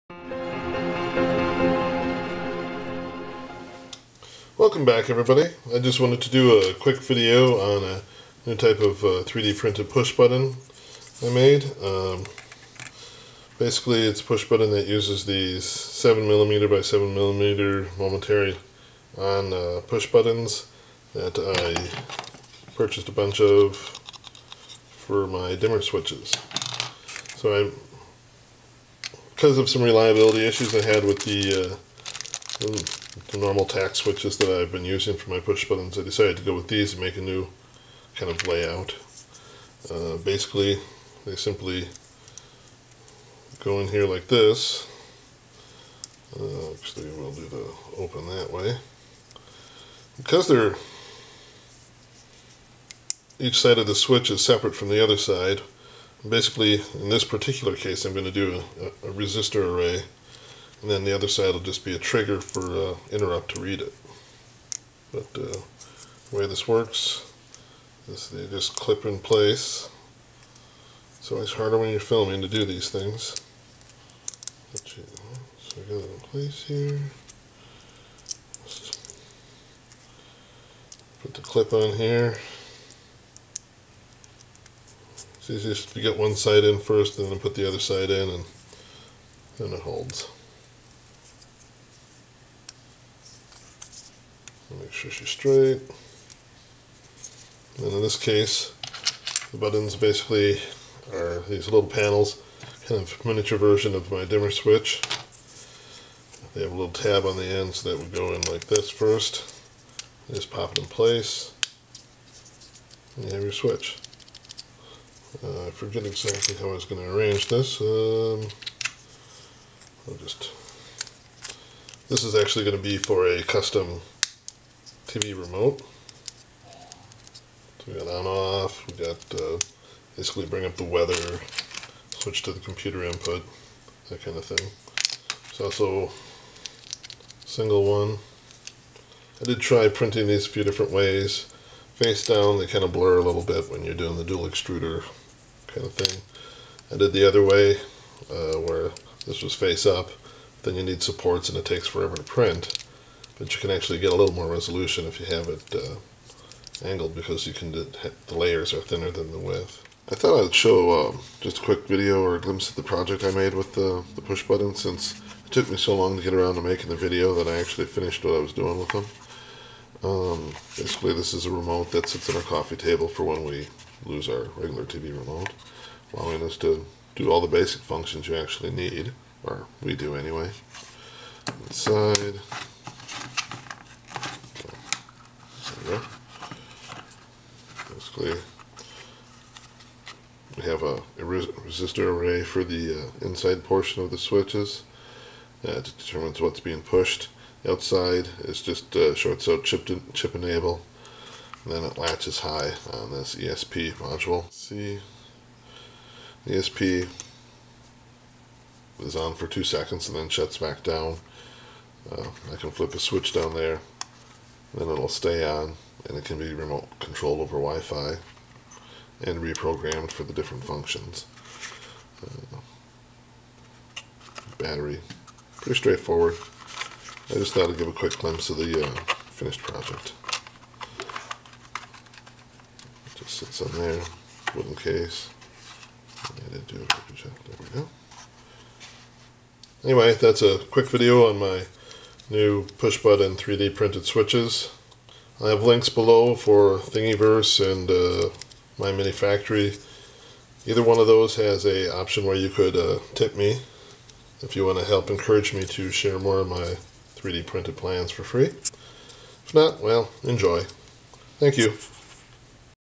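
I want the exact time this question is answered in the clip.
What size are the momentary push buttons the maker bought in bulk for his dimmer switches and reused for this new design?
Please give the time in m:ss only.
0:15.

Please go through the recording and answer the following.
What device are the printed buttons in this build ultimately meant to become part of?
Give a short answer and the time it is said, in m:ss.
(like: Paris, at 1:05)
Custom TV remote, at 2:03.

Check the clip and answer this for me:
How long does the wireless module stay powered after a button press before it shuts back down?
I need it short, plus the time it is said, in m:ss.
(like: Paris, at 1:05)
2 seconds, at 3:29.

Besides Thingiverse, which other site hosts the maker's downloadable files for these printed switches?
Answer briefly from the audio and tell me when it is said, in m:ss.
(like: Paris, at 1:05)
MyMiniFactory, at 4:08.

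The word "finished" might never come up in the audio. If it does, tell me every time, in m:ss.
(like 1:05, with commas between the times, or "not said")
2:47, 3:49.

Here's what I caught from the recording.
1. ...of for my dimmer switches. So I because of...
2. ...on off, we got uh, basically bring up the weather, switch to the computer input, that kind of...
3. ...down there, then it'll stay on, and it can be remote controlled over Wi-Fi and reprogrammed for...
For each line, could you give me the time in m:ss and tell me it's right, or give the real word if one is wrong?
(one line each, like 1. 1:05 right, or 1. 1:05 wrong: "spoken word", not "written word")
1. 0:23 right
2. 2:08 right
3. 3:33 right.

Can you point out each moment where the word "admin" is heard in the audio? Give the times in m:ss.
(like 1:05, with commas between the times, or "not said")
not said.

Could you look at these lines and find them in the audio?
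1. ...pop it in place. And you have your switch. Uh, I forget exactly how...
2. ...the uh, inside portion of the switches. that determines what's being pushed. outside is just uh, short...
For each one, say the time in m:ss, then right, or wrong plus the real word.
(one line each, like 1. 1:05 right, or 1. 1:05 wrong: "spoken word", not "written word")
1. 1:50 right
2. 3:12 right.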